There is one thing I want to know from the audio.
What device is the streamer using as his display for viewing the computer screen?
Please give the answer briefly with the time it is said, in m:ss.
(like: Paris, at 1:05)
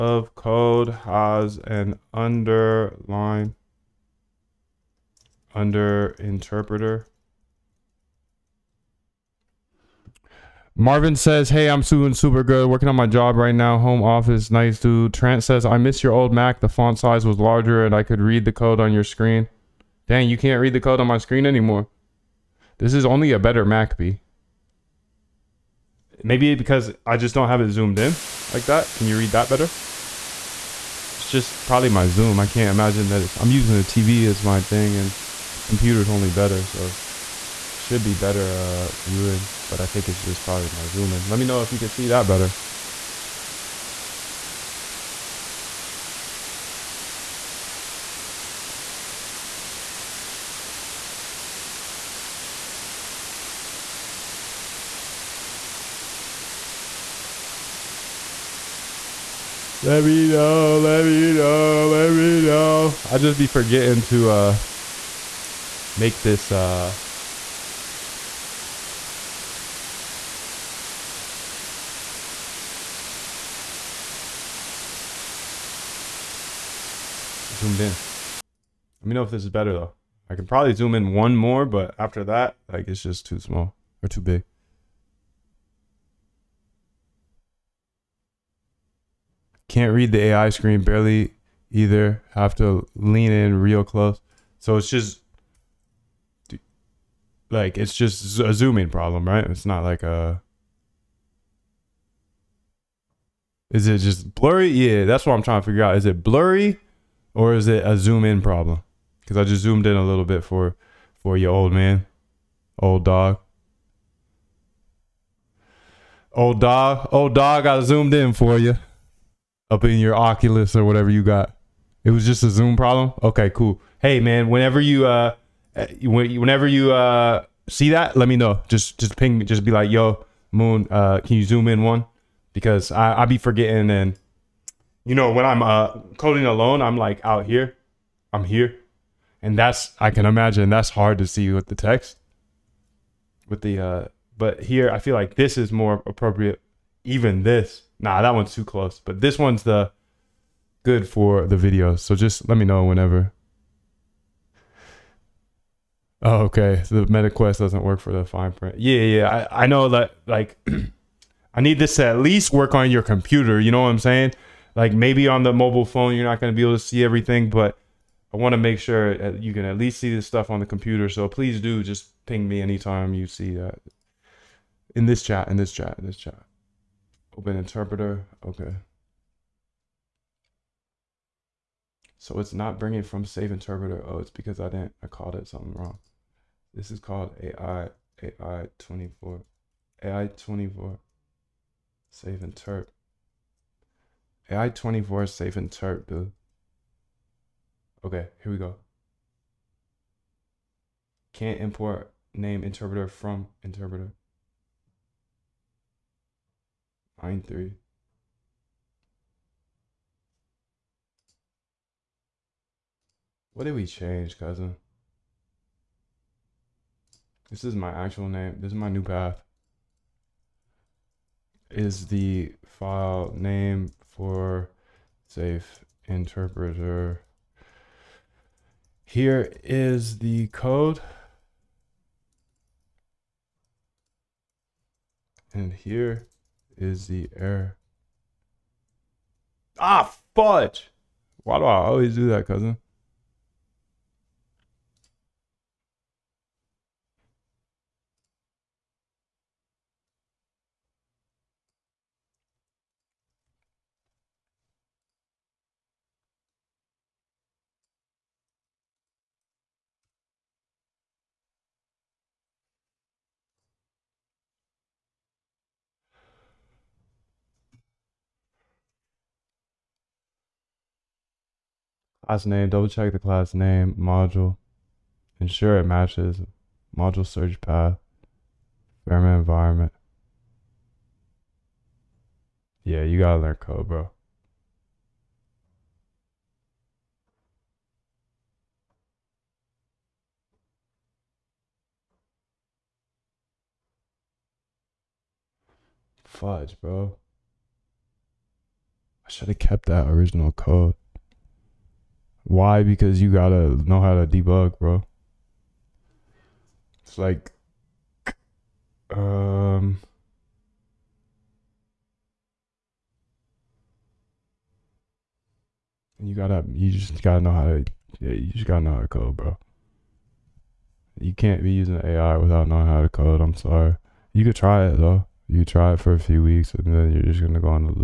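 The TV, at 0:33.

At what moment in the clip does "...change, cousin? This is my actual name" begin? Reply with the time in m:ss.
3:33.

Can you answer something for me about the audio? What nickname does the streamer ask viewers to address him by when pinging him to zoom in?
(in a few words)
Moon.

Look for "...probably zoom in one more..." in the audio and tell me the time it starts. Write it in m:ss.
1:20.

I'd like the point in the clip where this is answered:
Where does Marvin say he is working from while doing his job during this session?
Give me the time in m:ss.
0:13.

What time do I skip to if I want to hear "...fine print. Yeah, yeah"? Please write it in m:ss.
2:38.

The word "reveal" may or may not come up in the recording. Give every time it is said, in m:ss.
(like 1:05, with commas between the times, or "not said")
not said.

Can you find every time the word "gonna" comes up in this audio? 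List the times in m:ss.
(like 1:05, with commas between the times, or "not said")
2:46, 5:27.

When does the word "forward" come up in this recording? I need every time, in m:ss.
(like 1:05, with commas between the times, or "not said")
not said.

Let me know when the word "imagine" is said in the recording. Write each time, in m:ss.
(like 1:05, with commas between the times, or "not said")
0:32, 2:20.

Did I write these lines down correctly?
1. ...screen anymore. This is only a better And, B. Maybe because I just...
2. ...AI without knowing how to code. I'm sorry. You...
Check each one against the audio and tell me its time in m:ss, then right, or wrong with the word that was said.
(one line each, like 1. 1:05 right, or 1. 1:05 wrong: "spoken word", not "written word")
1. 0:21 wrong: "Mac", not "And"
2. 5:22 right.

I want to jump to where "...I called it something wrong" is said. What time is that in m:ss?
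3:05.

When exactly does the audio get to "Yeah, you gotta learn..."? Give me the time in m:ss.
4:42.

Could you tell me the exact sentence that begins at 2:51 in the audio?
So please do just ping me anytime you see that in this chat, in this chat, in this chat.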